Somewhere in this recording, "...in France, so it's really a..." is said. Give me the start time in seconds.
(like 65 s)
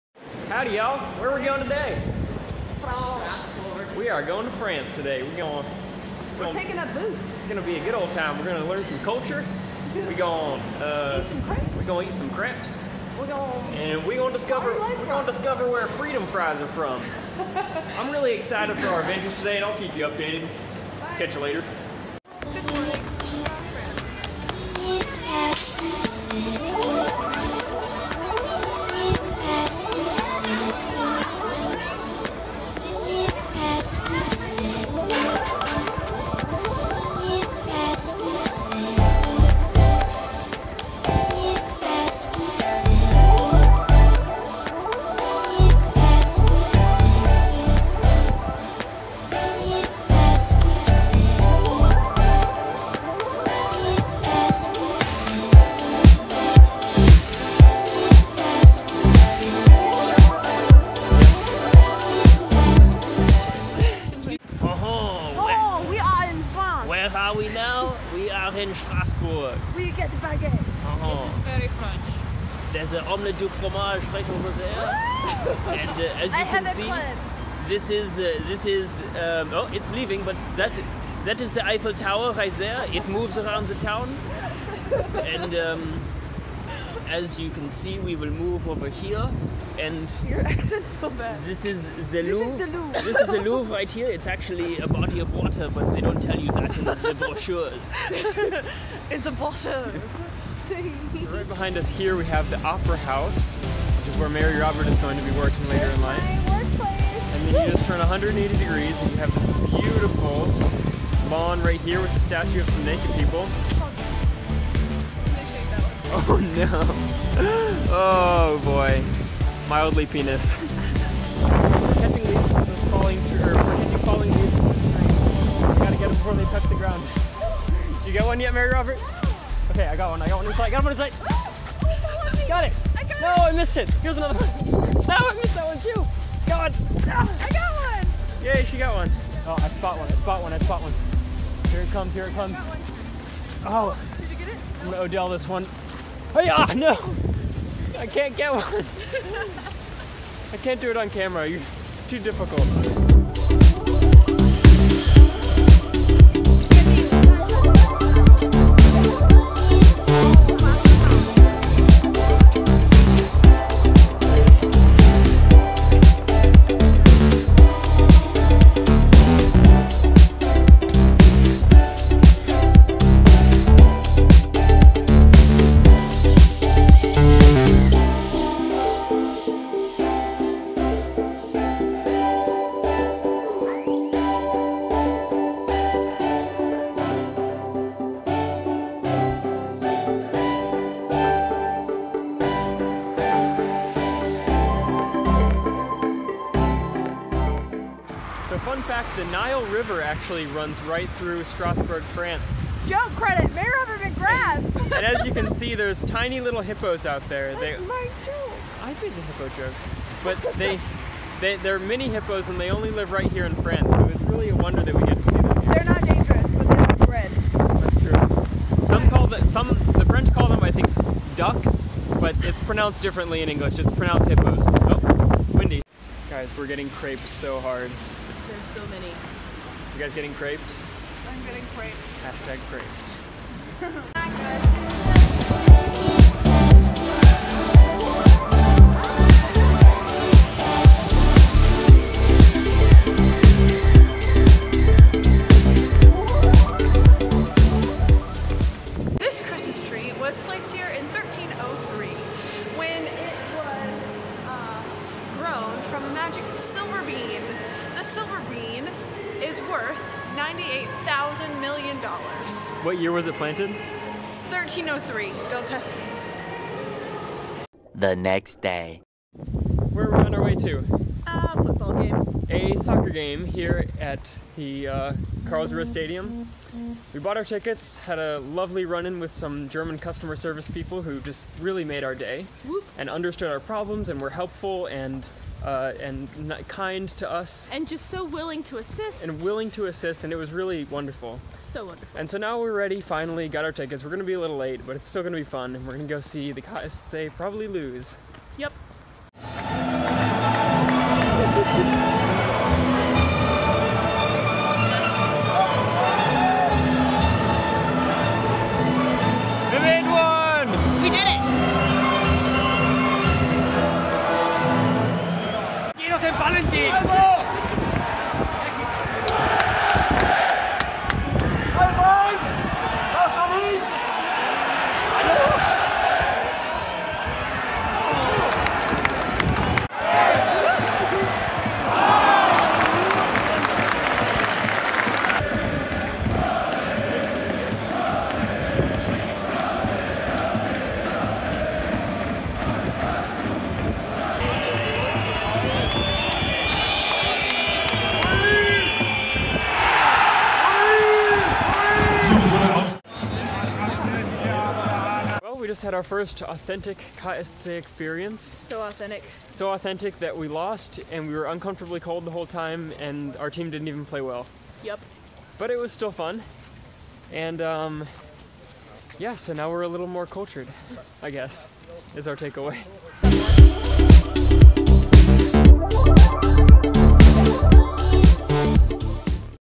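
213 s.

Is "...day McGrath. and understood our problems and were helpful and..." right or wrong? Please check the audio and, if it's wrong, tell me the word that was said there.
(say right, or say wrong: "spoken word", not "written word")
wrong: "Whoop", not "McGrath".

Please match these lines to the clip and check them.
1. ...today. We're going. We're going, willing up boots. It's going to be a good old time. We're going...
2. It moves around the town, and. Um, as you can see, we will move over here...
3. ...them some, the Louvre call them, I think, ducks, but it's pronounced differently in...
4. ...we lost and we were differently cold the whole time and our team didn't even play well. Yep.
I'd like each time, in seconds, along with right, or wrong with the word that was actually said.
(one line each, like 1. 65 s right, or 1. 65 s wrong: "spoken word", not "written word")
1. 4 s wrong: "taking", not "willing"
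2. 82 s right
3. 219 s wrong: "French", not "Louvre"
4. 360 s wrong: "uncomfortably", not "differently".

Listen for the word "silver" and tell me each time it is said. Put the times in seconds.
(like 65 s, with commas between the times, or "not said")
258 s.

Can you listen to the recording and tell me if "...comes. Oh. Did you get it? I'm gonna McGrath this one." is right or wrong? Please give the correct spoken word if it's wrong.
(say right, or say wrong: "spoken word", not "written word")
wrong: "Odell", not "McGrath".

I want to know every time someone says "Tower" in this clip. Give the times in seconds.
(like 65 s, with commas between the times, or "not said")
81 s.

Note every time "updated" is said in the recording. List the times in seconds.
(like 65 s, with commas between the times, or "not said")
20 s.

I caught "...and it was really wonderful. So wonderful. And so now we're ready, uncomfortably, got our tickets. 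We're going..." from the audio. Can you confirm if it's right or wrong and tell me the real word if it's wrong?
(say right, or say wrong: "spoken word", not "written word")
wrong: "finally", not "uncomfortably".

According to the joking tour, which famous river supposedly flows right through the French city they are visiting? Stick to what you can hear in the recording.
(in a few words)
The Nile.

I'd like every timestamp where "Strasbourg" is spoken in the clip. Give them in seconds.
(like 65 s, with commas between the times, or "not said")
68 s, 201 s.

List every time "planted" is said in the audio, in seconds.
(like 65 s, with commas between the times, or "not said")
263 s.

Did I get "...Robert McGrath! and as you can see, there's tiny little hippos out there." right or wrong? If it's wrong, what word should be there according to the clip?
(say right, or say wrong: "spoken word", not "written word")
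right.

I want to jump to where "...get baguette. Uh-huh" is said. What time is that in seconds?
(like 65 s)
69 s.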